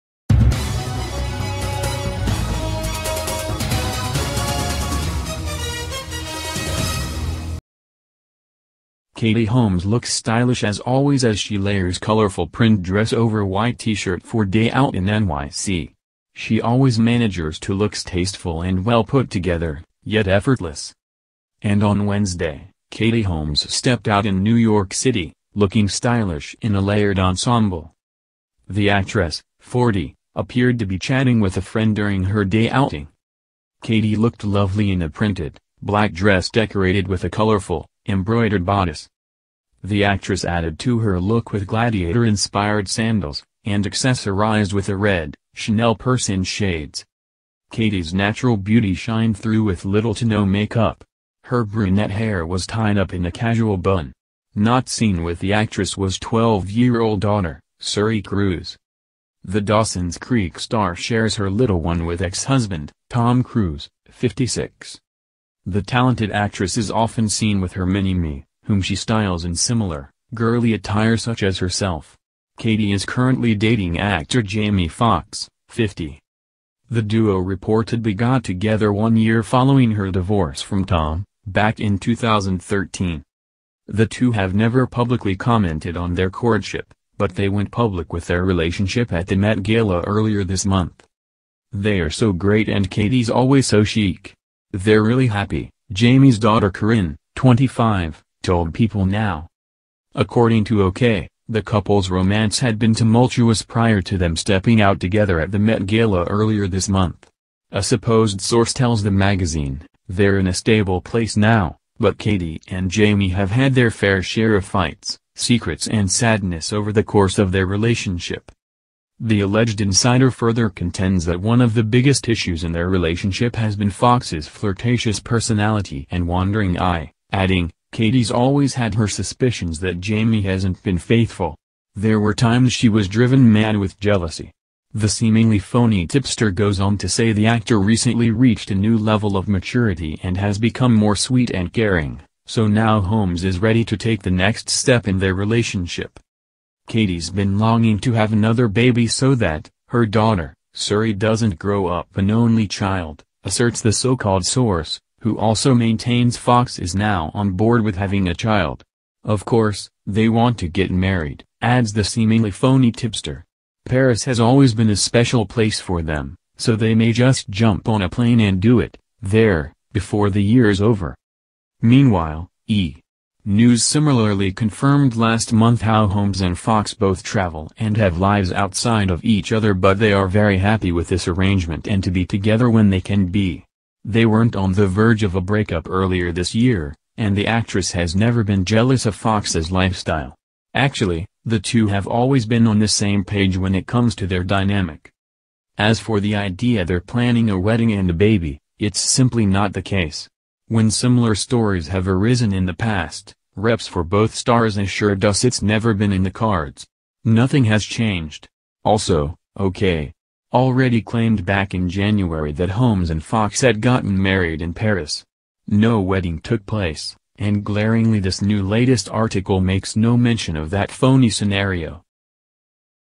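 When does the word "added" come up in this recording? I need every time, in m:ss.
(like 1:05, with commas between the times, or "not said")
0:40.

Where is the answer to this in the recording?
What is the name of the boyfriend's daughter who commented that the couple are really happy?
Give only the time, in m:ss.
1:36.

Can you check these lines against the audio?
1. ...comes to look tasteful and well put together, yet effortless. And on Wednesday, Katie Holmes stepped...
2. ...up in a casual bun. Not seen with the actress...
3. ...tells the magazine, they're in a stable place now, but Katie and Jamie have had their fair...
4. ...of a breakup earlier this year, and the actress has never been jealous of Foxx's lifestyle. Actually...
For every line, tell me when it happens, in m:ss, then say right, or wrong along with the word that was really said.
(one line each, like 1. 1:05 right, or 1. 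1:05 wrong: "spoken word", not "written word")
1. 0:16 wrong: "manages", not "comes"
2. 0:52 right
3. 1:48 right
4. 3:05 right.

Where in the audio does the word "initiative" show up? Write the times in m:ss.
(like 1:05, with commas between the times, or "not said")
not said.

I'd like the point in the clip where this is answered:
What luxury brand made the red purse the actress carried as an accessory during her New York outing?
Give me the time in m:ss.
0:45.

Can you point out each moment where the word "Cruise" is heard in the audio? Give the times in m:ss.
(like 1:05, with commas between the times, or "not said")
0:58, 1:03.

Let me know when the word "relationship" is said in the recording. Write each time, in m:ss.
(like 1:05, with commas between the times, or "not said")
1:28, 1:57, 2:02, 2:25.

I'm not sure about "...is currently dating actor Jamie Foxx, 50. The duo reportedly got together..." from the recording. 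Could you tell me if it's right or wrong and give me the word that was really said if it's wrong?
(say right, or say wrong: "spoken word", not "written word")
right.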